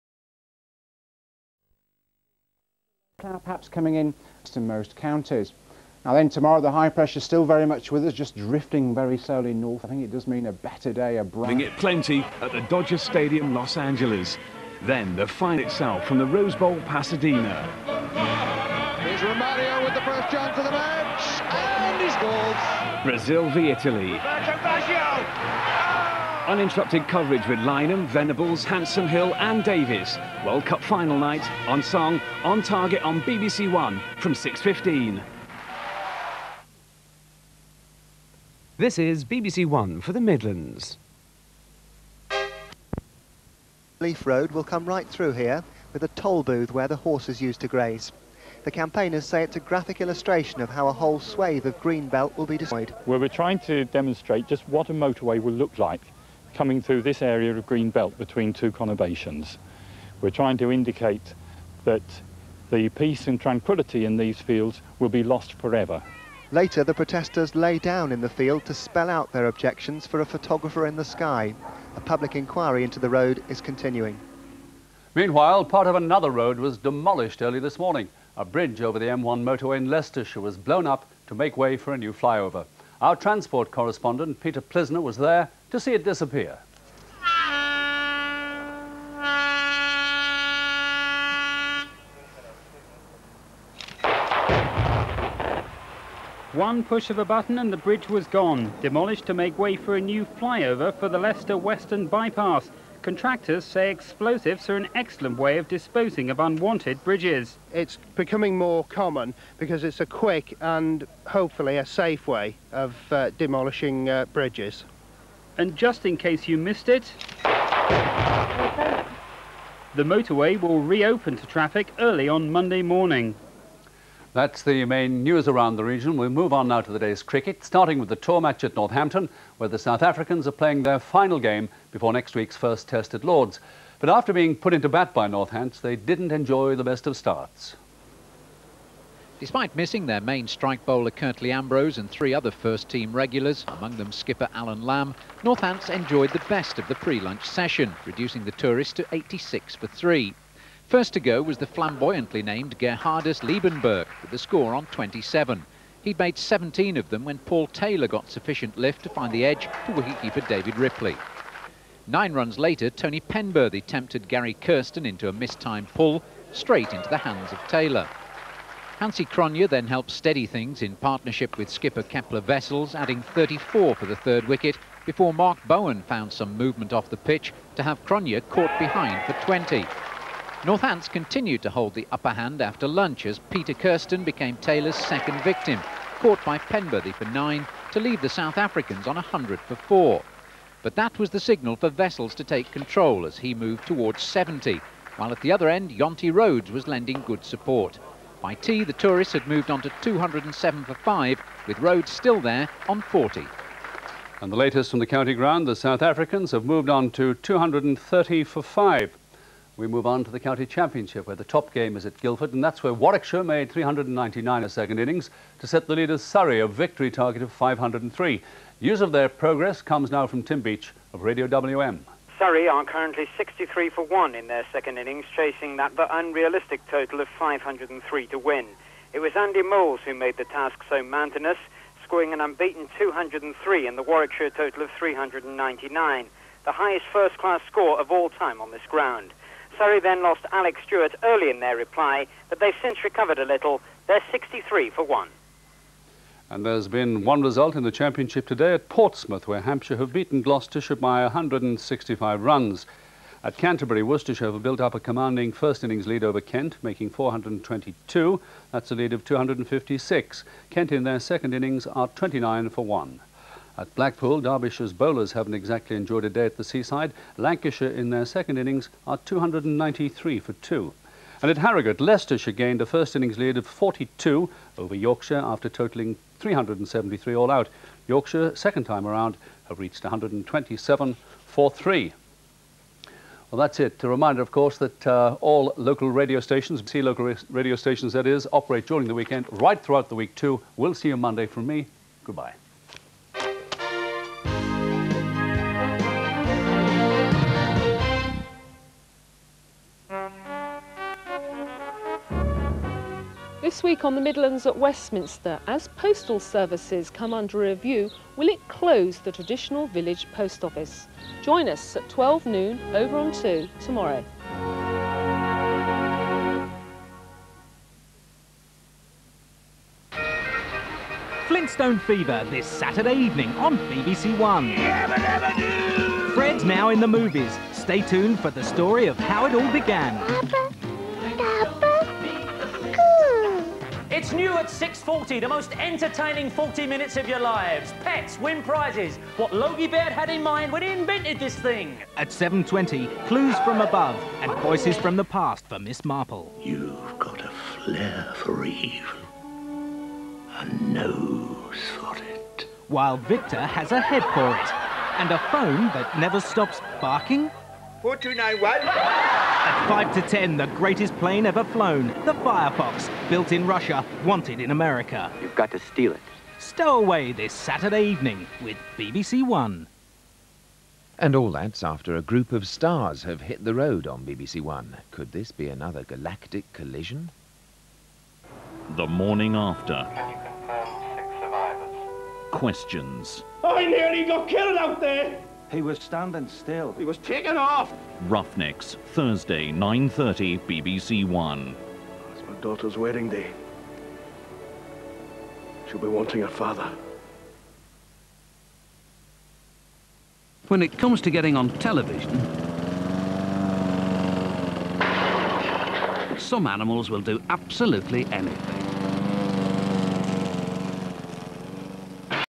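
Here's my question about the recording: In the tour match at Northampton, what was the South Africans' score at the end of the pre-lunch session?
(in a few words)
86 for 3.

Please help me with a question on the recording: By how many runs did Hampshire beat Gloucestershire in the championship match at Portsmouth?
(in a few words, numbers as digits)
165.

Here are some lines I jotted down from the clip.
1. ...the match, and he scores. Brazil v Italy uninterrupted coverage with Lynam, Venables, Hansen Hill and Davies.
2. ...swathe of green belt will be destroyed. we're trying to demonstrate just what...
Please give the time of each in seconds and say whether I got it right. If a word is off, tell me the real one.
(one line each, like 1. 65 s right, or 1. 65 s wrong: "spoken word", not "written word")
1. 20 s right
2. 51 s right.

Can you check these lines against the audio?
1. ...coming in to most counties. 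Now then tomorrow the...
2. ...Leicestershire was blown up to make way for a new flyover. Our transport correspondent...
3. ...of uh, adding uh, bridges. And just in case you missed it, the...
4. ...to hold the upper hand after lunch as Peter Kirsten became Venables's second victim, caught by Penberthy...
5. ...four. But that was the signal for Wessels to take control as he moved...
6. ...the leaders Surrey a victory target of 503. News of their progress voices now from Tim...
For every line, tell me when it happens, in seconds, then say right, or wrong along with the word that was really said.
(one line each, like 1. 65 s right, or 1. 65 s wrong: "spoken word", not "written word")
1. 3 s right
2. 79 s right
3. 112 s wrong: "demolishing", not "adding"
4. 181 s wrong: "Taylor", not "Venables"
5. 189 s right
6. 215 s wrong: "comes", not "voices".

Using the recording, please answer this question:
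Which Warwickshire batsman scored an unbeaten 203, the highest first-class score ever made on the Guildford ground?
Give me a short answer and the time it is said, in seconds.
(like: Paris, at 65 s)
Andy Moles, at 229 s.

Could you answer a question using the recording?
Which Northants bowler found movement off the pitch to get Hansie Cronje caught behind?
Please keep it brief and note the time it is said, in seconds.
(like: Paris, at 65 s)
Mark Bowen, at 175 s.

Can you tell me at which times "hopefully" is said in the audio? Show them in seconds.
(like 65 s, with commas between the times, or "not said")
111 s.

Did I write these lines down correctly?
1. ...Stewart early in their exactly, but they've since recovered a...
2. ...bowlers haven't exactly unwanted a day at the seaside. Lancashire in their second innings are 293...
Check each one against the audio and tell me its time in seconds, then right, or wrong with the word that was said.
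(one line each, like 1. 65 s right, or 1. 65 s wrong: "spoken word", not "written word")
1. 240 s wrong: "reply", not "exactly"
2. 264 s wrong: "enjoyed", not "unwanted".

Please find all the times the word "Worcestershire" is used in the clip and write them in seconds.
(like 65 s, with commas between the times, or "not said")
254 s.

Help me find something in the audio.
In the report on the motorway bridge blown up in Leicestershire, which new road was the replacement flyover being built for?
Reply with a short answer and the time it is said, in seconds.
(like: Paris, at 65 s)
Leicester Western Bypass, at 101 s.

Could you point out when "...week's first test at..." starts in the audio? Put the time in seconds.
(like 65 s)
132 s.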